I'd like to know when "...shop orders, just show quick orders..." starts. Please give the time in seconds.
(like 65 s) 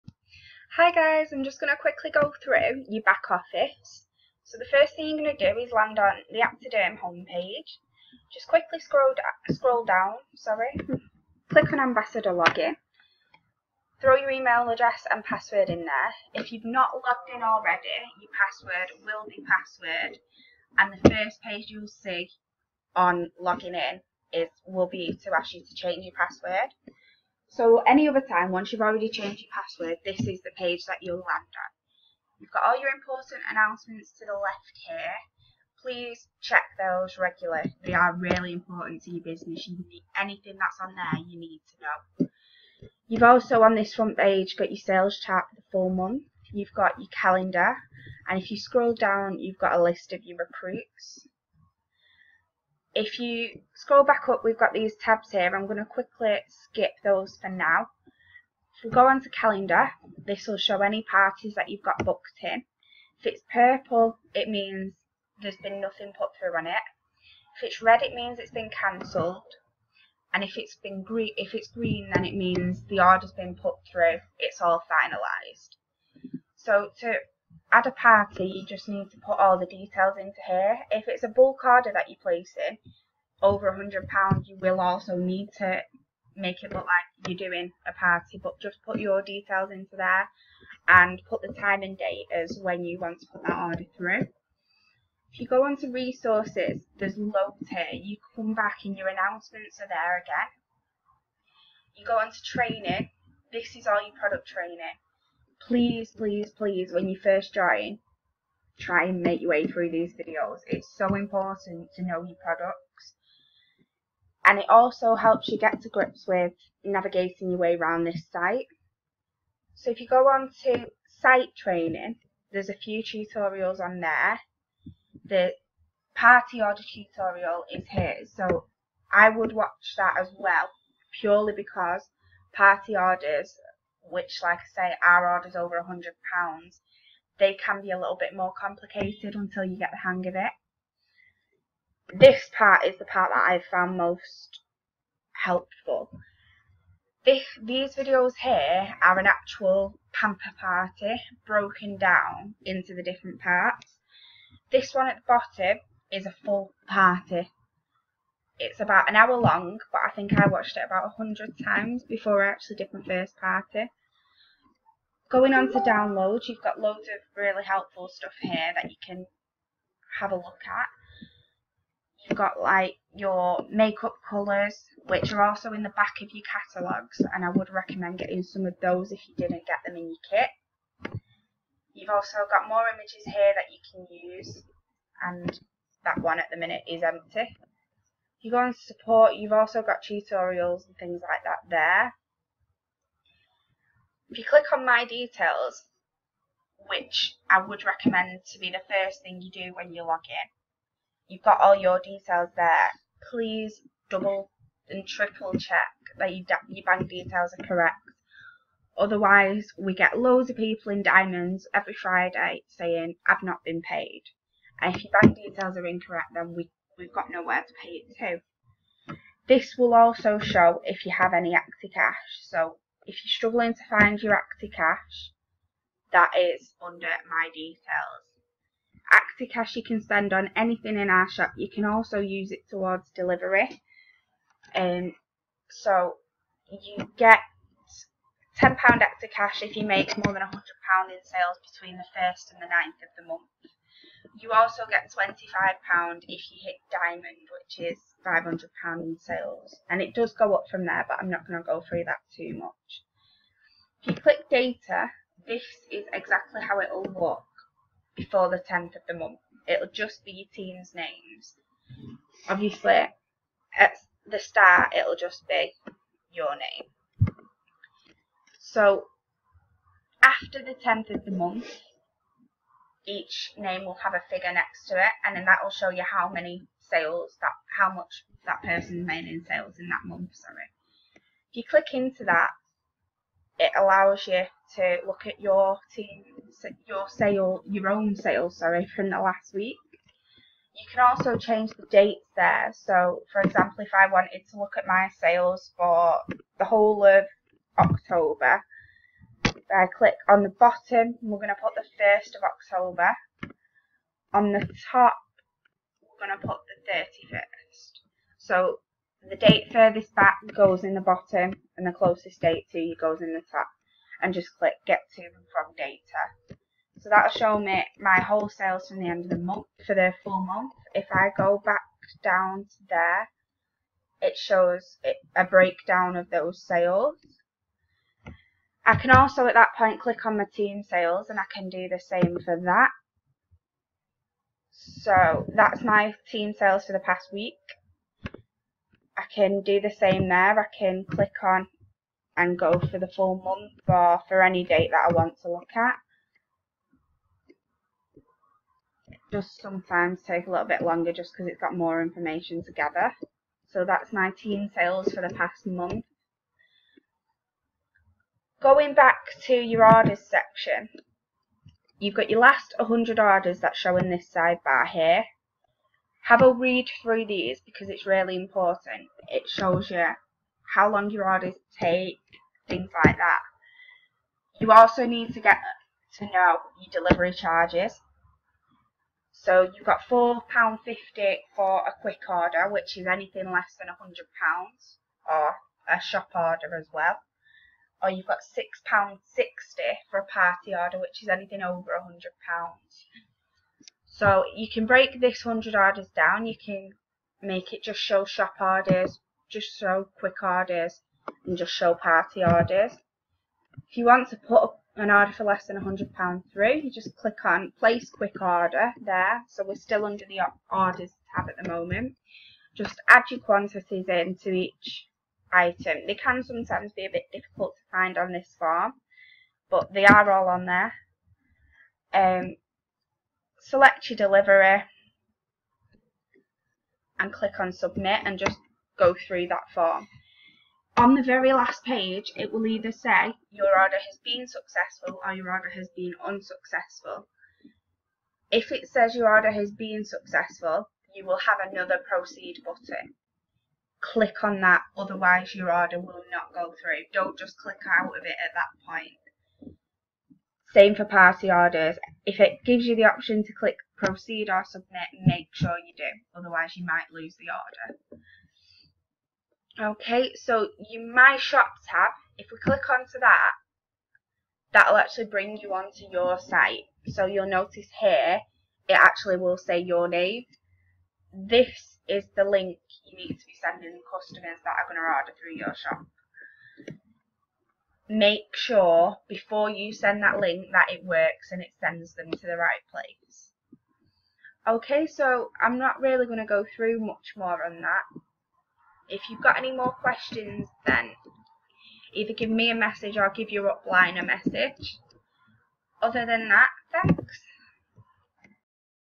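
398 s.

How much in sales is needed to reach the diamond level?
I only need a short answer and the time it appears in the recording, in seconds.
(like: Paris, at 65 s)
£500, at 248 s.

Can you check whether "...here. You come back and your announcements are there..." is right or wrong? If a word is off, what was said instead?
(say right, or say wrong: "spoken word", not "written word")
right.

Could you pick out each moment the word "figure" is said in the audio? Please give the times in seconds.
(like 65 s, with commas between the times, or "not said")
274 s.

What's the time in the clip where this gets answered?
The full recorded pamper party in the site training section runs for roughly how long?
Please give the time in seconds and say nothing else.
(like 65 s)
158 s.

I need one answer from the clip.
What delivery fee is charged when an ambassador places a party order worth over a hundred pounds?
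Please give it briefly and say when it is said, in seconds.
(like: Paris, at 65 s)
£6.60, at 388 s.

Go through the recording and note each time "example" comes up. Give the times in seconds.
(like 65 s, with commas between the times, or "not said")
293 s.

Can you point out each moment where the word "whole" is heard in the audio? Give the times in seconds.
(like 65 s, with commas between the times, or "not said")
296 s, 318 s.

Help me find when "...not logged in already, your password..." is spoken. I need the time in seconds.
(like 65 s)
16 s.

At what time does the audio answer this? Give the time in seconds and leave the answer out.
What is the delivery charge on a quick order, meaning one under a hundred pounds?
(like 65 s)
380 s.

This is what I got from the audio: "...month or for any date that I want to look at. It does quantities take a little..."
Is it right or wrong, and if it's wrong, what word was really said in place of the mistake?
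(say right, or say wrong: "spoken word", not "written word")
wrong: "sometimes", not "quantities".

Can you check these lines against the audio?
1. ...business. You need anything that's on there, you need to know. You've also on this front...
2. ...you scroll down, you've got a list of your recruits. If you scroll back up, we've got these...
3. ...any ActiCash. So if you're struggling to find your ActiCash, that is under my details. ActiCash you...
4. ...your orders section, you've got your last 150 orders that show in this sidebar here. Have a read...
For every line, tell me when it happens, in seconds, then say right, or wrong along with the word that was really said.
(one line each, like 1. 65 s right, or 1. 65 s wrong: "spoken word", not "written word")
1. 39 s right
2. 48 s right
3. 221 s right
4. 359 s wrong: "100", not "150".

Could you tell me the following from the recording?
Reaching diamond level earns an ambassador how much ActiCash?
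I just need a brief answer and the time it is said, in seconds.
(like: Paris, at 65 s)
£25, at 245 s.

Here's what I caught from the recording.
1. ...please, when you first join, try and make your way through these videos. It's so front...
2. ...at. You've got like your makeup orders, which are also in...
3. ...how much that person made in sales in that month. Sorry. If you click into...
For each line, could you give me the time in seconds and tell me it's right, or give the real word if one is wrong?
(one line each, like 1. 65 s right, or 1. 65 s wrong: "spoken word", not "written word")
1. 106 s wrong: "important", not "front"
2. 170 s wrong: "colours", not "orders"
3. 277 s right.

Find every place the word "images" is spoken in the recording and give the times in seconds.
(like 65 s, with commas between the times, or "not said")
182 s.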